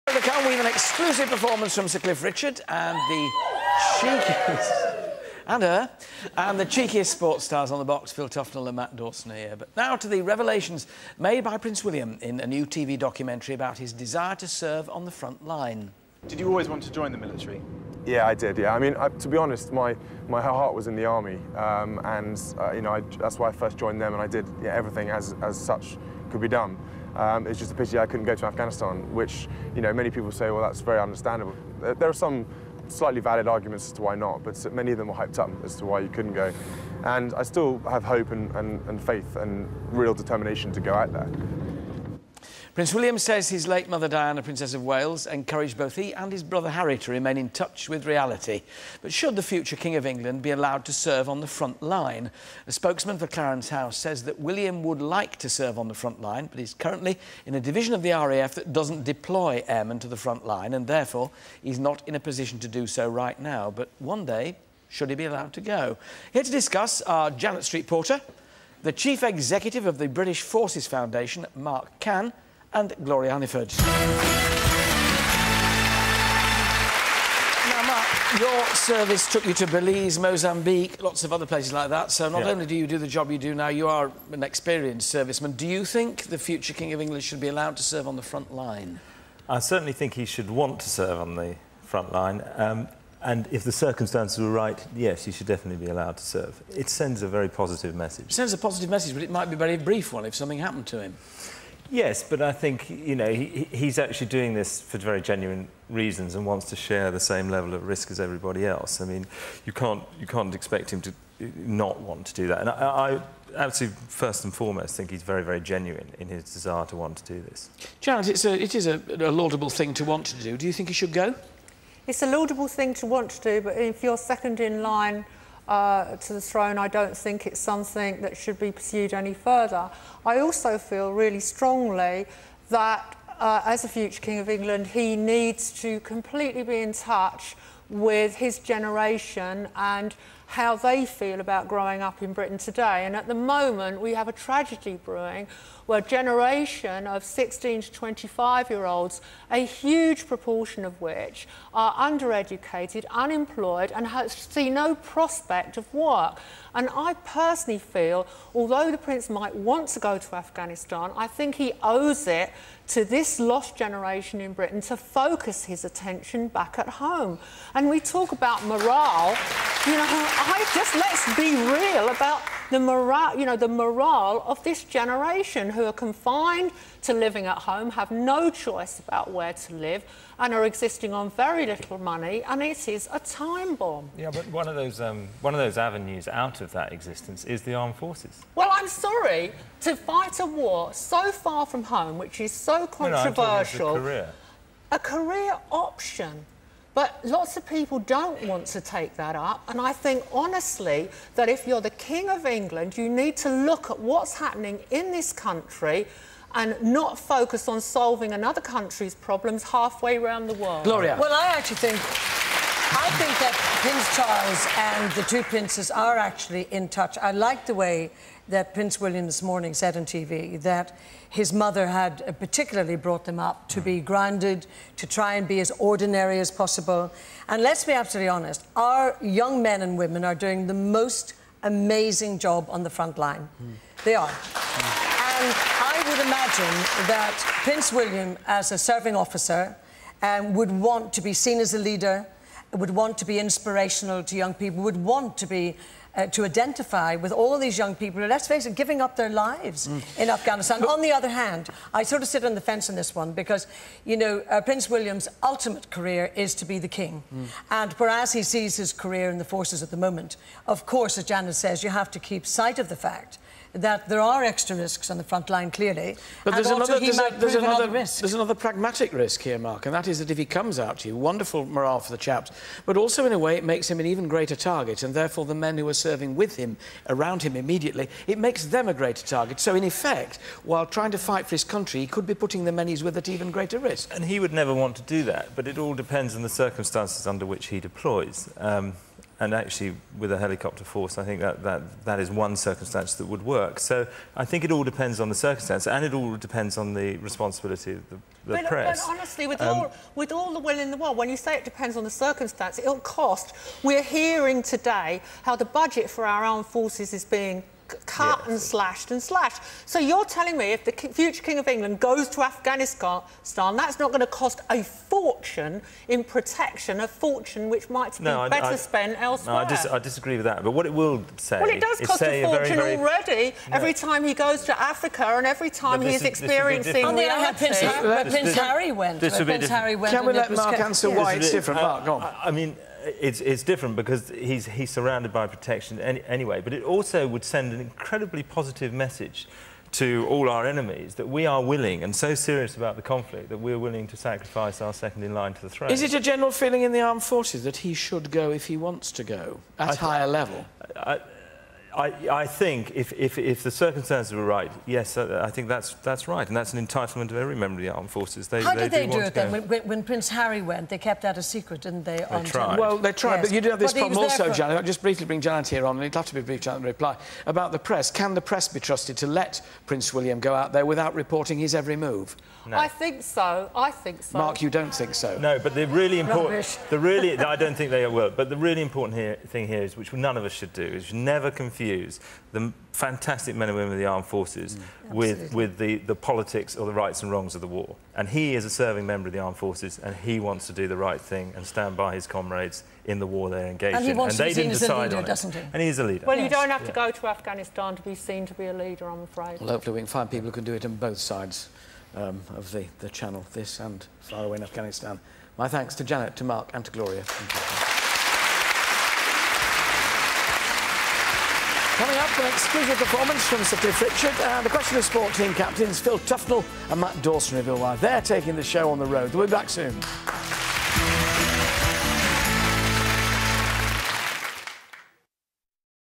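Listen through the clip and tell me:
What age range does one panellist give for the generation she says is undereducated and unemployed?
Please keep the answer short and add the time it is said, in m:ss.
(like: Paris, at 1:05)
16 to 25, at 2:27.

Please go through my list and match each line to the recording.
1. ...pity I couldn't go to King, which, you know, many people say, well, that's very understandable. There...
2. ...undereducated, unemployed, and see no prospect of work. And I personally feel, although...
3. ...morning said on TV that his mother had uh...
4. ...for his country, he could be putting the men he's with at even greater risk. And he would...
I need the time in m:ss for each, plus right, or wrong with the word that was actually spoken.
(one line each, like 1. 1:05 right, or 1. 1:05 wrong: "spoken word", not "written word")
1. 0:27 wrong: "Afghanistan", not "King"
2. 2:31 right
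3. 3:39 right
4. 4:41 right.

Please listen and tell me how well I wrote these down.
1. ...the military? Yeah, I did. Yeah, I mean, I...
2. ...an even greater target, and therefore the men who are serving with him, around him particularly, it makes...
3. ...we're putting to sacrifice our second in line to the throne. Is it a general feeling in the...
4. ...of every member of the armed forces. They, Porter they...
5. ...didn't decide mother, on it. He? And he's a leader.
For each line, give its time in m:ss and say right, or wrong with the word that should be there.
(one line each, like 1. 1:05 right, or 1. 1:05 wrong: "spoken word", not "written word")
1. 0:17 right
2. 4:33 wrong: "immediately", not "particularly"
3. 5:43 wrong: "willing", not "putting"
4. 5:57 wrong: "How", not "Porter"
5. 6:34 wrong: "leader", not "mother".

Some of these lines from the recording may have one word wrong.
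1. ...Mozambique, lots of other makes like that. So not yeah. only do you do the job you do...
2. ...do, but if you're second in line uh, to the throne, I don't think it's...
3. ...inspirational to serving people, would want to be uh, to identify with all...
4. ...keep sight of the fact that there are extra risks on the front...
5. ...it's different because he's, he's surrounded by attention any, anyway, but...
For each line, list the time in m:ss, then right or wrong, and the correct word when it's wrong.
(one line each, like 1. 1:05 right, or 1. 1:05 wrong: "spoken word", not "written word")
1. 1:20 wrong: "places", not "makes"
2. 2:03 right
3. 4:03 wrong: "young", not "serving"
4. 4:22 right
5. 5:33 wrong: "protection", not "attention".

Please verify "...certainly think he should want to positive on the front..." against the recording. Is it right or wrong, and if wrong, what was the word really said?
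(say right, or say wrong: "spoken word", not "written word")
wrong: "serve", not "positive".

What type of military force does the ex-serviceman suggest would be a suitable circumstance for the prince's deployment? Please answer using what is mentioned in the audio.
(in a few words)
helicopter force.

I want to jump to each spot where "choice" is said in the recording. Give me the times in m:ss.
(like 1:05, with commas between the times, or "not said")
2:58.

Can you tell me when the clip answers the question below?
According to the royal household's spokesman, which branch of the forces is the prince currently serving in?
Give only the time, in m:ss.
0:58.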